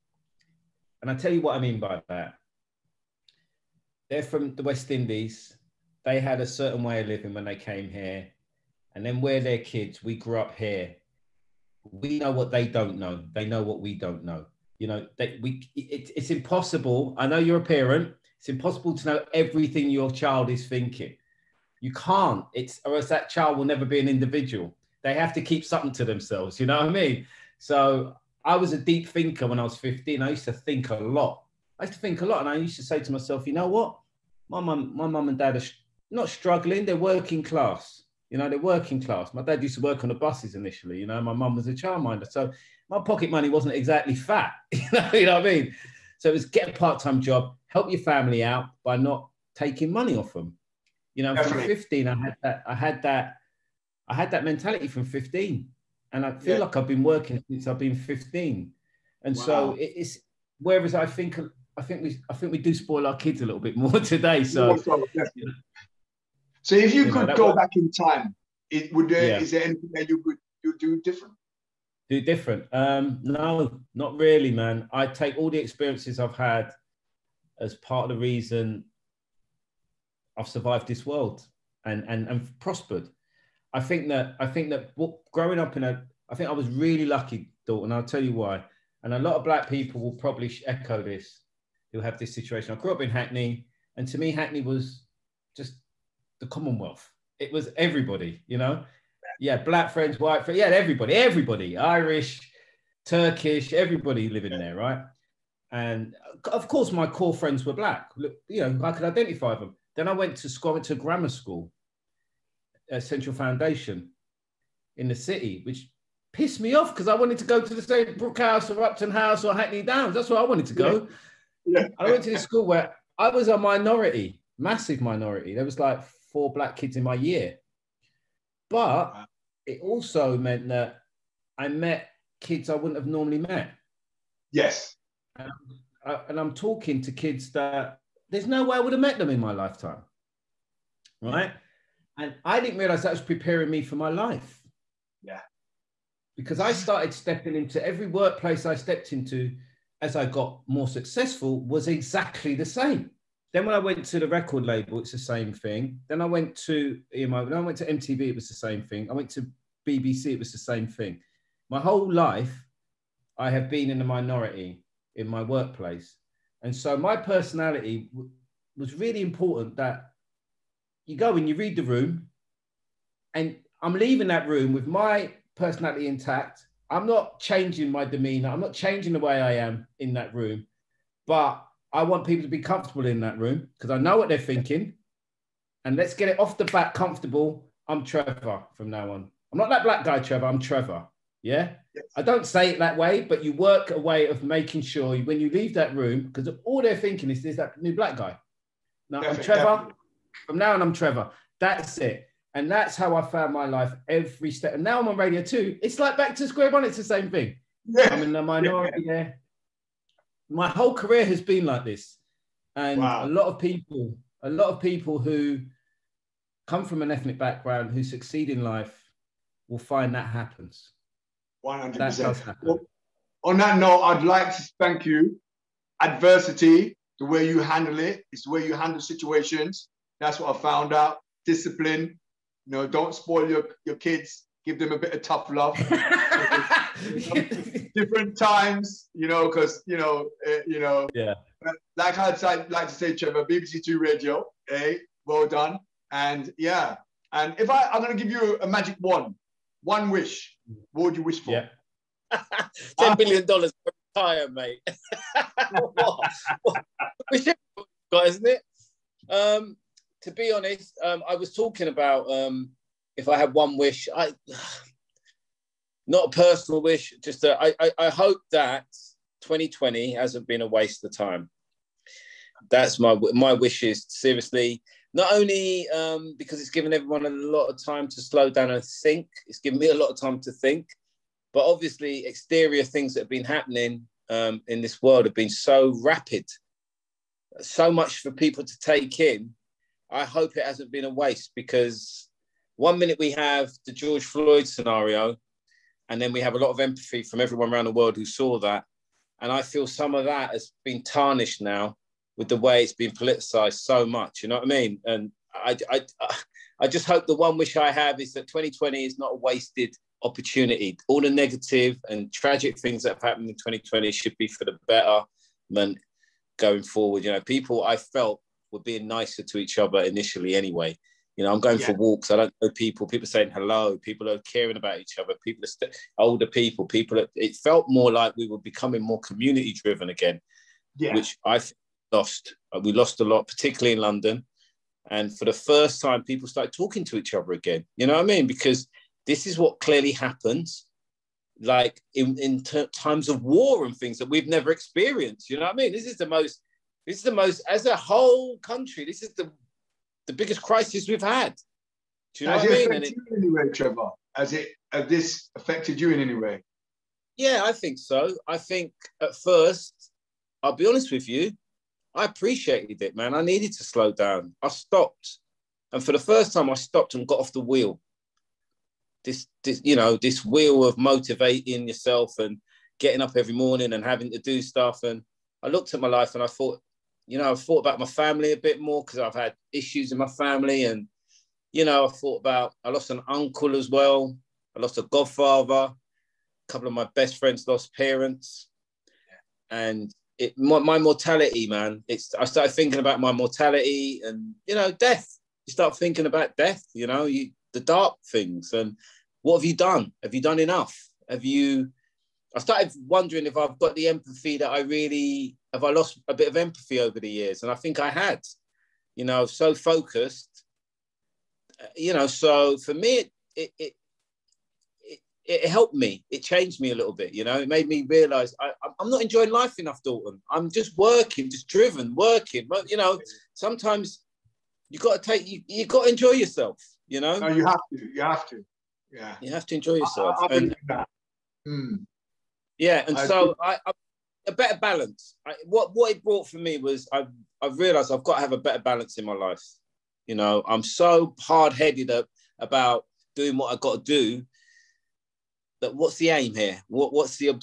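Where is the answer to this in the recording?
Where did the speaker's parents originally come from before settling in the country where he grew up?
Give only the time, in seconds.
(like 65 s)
4 s.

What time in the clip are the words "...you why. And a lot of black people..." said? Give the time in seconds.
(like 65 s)
88 s.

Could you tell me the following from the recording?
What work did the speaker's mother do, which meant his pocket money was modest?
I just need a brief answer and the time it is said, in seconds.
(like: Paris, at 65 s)
Childminder, at 41 s.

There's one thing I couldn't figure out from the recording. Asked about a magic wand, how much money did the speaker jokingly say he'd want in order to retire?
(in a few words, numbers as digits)
10 billion dollars.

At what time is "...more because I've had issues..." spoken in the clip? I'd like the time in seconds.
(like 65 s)
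378 s.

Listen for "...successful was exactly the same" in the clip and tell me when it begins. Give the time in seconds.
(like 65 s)
150 s.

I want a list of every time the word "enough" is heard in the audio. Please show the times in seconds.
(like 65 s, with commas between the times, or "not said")
400 s, 419 s.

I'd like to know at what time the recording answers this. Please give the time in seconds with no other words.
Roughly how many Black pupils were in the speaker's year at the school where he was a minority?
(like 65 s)
126 s.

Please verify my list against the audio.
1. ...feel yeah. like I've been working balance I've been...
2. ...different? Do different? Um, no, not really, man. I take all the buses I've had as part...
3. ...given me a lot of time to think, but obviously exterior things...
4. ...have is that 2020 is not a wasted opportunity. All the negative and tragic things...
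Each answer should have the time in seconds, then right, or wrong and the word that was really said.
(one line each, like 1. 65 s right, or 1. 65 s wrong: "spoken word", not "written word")
1. 56 s wrong: "since", not "balance"
2. 71 s wrong: "experiences", not "buses"
3. 279 s right
4. 307 s right.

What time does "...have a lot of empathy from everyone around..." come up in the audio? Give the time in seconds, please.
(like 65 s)
296 s.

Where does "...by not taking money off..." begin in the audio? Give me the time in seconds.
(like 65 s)
48 s.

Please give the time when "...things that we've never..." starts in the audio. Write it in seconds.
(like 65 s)
343 s.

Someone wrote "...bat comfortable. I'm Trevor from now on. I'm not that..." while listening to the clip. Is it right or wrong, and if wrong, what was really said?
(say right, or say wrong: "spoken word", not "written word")
right.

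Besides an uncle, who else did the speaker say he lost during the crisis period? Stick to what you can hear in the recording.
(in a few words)
A godfather.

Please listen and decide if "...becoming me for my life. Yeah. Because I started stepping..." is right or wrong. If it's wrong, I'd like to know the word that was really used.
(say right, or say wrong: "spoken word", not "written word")
wrong: "preparing", not "becoming".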